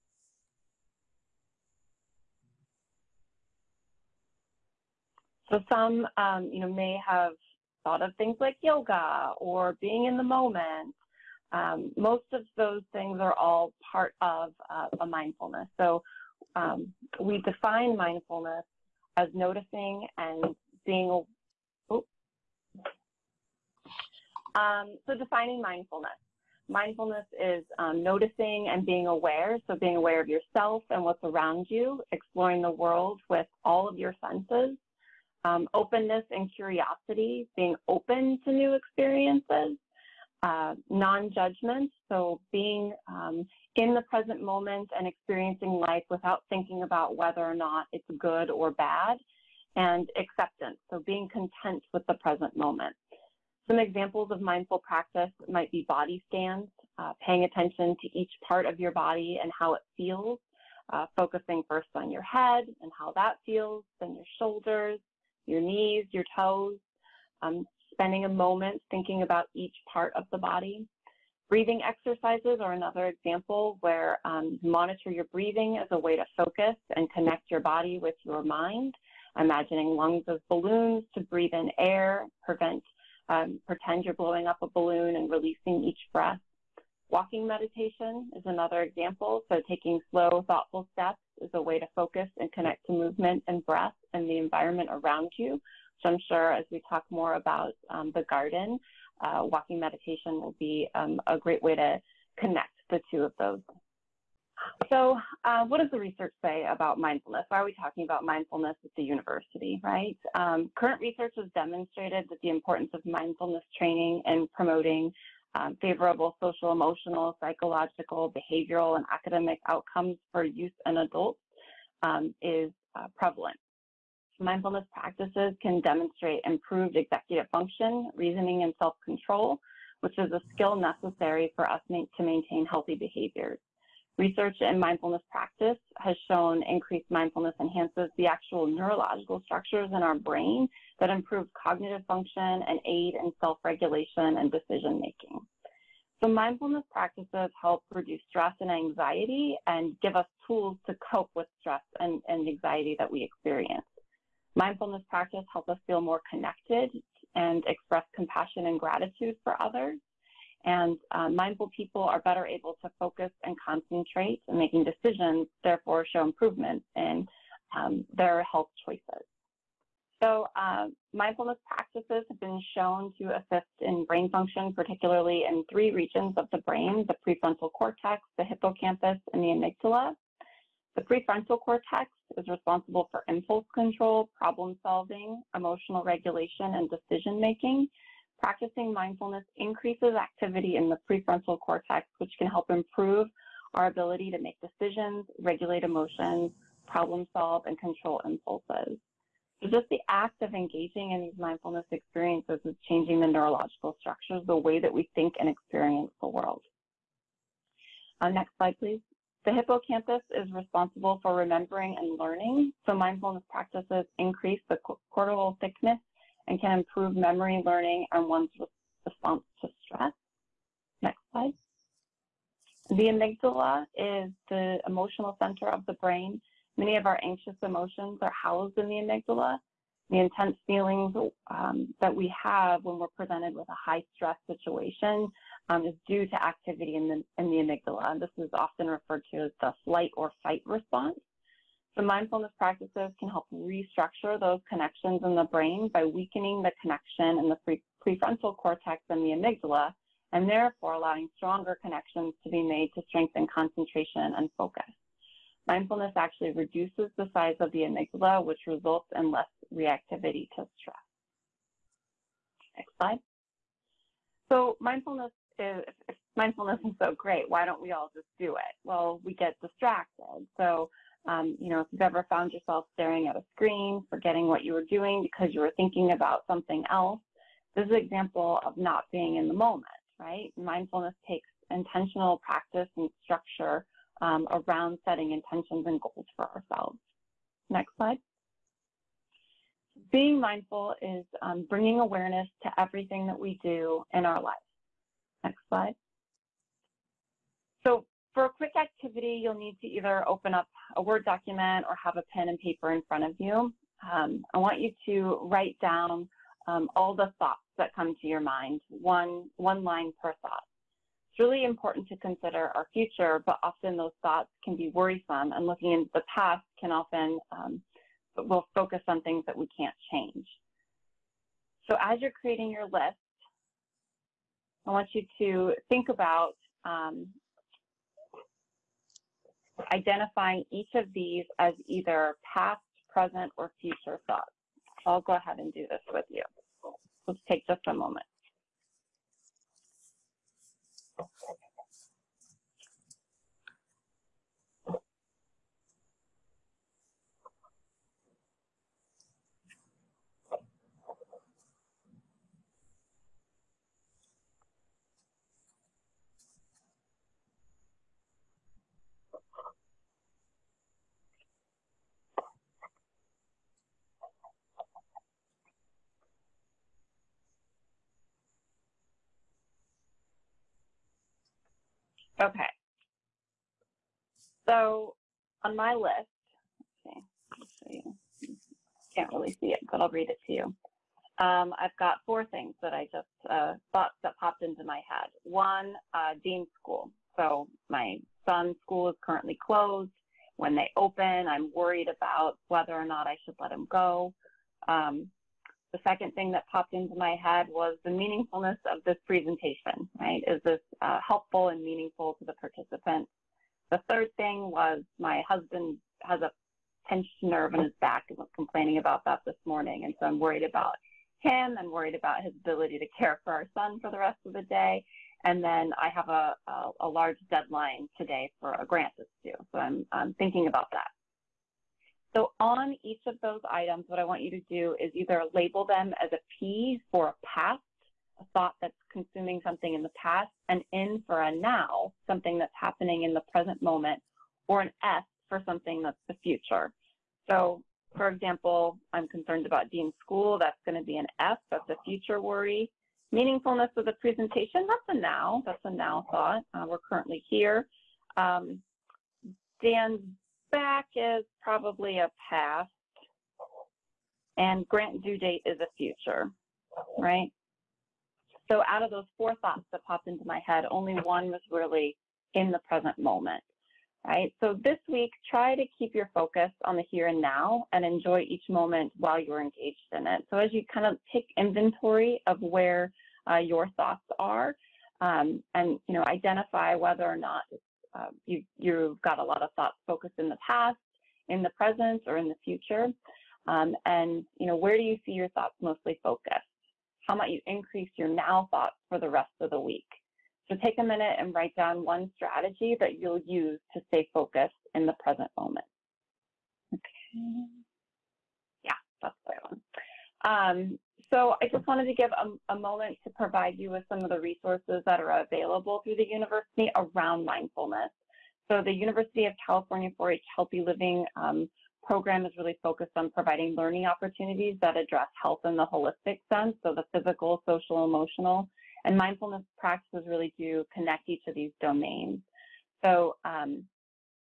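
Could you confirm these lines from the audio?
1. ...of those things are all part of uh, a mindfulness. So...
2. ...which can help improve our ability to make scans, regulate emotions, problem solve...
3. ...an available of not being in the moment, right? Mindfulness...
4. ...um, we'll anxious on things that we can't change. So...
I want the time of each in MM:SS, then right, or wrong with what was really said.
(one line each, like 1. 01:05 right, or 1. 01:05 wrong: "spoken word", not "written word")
1. 00:12 right
2. 03:12 wrong: "decisions", not "scans"
3. 04:37 wrong: "example", not "available"
4. 05:17 wrong: "focus", not "anxious".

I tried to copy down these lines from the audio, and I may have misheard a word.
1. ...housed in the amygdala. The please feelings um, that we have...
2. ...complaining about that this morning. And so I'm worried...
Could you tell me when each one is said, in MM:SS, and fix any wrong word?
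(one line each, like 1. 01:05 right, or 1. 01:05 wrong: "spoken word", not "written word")
1. 03:48 wrong: "intense", not "please"
2. 06:48 right.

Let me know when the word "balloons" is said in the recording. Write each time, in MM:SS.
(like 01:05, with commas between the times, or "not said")
01:20, 01:24.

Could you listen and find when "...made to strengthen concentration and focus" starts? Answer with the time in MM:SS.
04:12.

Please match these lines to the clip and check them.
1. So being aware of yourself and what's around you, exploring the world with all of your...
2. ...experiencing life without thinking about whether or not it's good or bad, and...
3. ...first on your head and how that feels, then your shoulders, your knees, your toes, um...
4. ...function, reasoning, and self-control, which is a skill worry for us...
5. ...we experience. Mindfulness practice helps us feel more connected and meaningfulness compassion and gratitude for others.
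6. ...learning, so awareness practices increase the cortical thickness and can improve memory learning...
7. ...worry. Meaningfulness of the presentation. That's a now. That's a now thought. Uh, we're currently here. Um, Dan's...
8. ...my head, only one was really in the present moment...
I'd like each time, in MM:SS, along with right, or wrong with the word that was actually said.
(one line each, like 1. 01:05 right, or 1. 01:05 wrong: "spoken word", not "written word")
1. 00:29 right
2. 00:45 right
3. 01:01 right
4. 02:07 wrong: "necessary", not "worry"
5. 02:33 wrong: "express", not "meaningfulness"
6. 03:32 wrong: "mindfulness", not "awareness"
7. 07:22 right
8. 07:40 right.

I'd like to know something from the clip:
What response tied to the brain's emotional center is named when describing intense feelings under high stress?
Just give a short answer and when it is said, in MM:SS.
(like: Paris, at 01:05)
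Flight or fight response, at 03:59.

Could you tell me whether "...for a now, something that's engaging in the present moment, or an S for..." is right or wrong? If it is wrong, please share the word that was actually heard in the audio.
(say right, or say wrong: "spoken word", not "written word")
wrong: "happening", not "engaging".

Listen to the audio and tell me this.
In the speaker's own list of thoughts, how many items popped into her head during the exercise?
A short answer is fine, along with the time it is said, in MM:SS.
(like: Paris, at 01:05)
4, at 06:22.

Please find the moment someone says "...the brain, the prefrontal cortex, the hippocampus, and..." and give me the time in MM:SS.
02:56.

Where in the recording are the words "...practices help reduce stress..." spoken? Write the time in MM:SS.
02:26.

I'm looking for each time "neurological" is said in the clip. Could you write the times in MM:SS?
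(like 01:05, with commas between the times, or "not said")
02:18, 03:23.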